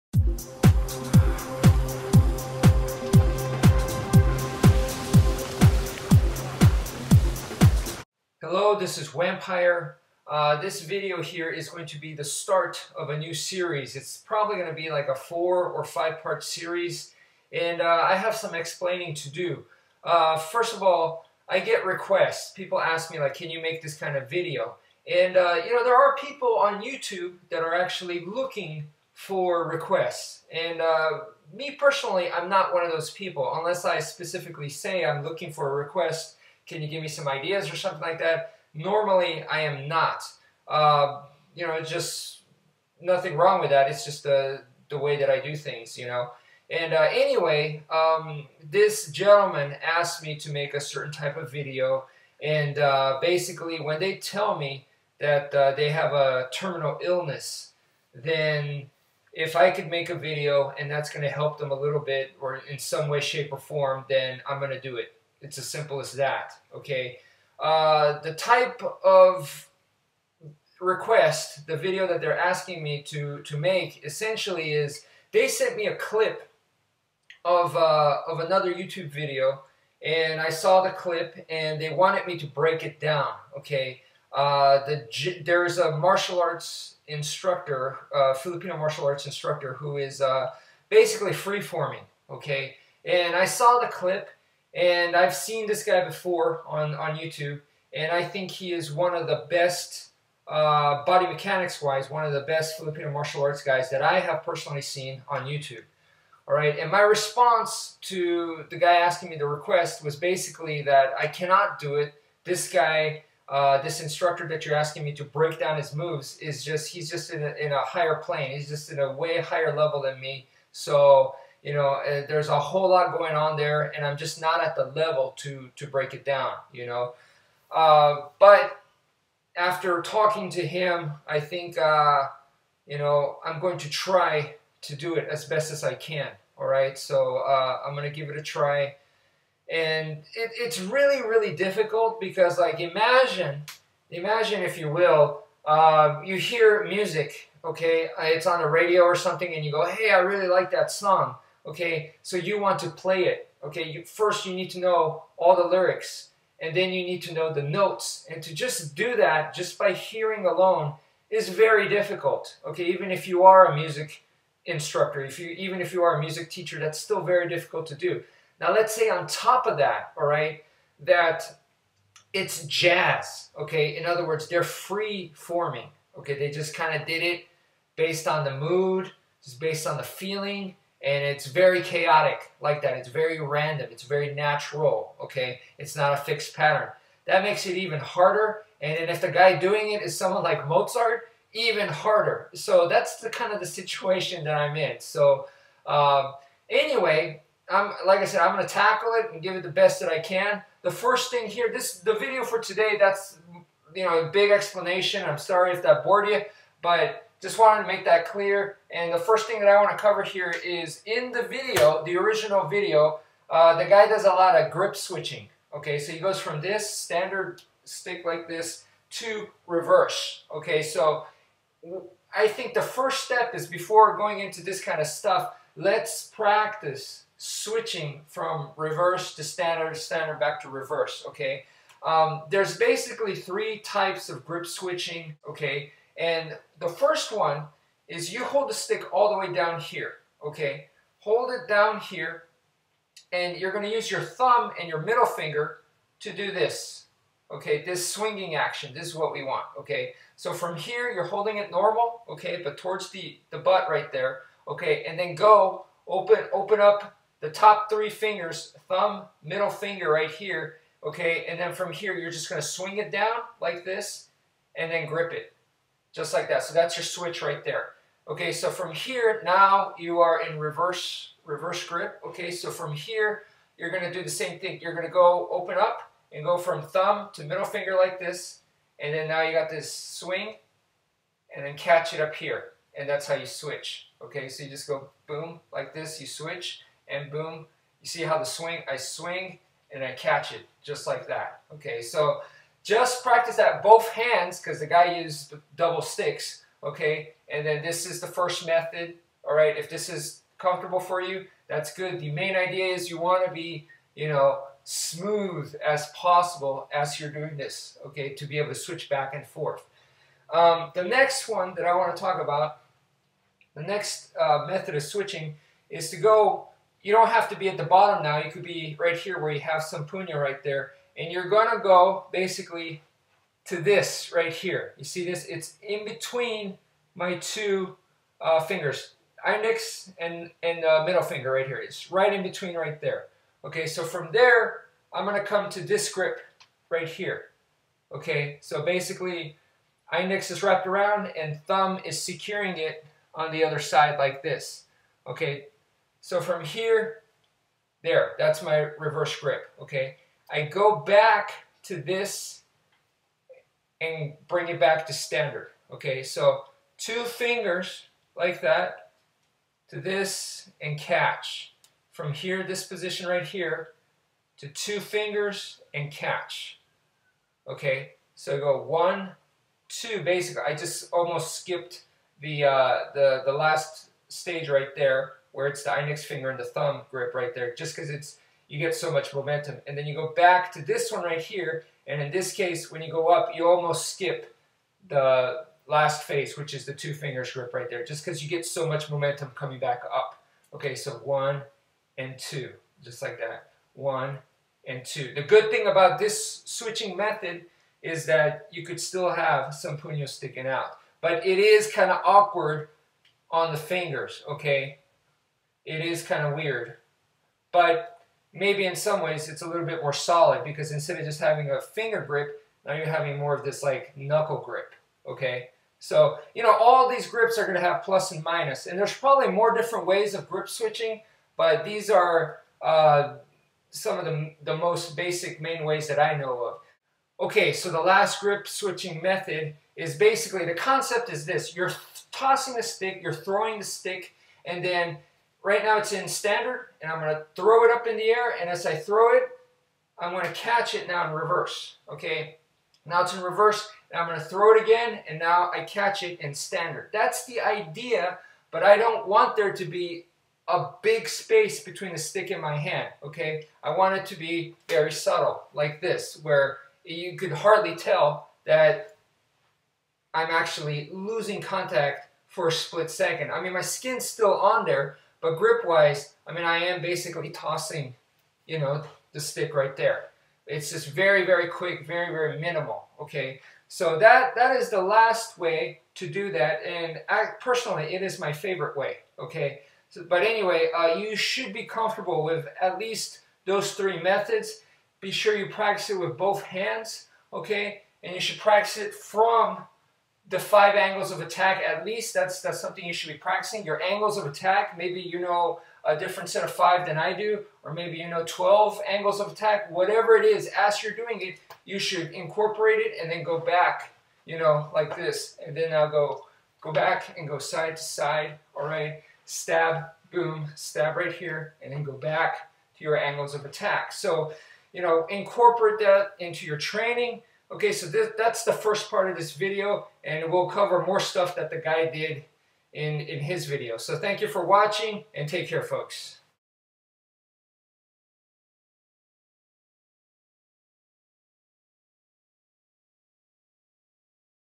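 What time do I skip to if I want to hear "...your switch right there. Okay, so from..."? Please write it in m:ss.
4:26.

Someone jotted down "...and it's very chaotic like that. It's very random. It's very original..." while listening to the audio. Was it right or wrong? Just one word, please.
wrong.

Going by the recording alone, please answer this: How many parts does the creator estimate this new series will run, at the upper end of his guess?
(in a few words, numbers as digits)
5.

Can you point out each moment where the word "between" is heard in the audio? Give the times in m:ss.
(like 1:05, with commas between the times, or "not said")
5:26, 5:32, 7:31.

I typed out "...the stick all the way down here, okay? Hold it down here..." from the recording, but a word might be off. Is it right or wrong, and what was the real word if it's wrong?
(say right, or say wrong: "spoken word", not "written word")
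right.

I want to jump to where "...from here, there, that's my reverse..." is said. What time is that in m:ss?
5:46.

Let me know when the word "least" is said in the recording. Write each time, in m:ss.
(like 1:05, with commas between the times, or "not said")
8:02, 8:12.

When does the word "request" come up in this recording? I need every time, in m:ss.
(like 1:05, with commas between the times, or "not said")
0:21, 0:29, 0:35, 1:10, 1:49.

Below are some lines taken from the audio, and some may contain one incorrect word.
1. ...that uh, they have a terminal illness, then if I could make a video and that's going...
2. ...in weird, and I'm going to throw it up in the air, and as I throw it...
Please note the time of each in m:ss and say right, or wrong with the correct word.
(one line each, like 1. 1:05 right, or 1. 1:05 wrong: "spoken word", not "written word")
1. 0:55 right
2. 7:16 wrong: "standard", not "weird".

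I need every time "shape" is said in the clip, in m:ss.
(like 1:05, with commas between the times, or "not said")
1:03.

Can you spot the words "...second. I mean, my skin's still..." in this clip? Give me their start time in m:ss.
7:43.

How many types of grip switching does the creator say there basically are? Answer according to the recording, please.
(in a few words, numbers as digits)
3.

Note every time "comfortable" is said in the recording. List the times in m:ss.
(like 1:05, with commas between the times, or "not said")
5:00, 8:01.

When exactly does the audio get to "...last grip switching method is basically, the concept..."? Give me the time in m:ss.
7:08.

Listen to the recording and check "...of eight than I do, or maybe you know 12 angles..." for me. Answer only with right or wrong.
wrong.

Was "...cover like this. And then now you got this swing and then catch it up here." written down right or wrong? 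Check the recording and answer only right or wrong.
wrong.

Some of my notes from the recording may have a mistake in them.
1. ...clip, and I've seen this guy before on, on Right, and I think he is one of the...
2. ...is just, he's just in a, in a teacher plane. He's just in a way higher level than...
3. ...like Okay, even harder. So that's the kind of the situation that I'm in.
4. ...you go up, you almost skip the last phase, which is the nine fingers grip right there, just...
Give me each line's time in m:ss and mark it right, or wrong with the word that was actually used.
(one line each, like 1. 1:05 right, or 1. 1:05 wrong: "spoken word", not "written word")
1. 1:33 wrong: "YouTube", not "Right"
2. 1:56 wrong: "higher", not "teacher"
3. 3:10 wrong: "Mozart", not "Okay"
4. 6:23 wrong: "two", not "nine".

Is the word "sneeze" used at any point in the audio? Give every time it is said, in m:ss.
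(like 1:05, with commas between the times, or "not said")
not said.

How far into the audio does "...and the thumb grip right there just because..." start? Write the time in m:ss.
6:16.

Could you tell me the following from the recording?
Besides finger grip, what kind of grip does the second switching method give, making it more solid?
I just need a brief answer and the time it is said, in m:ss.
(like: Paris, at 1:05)
knuckle grip, at 6:54.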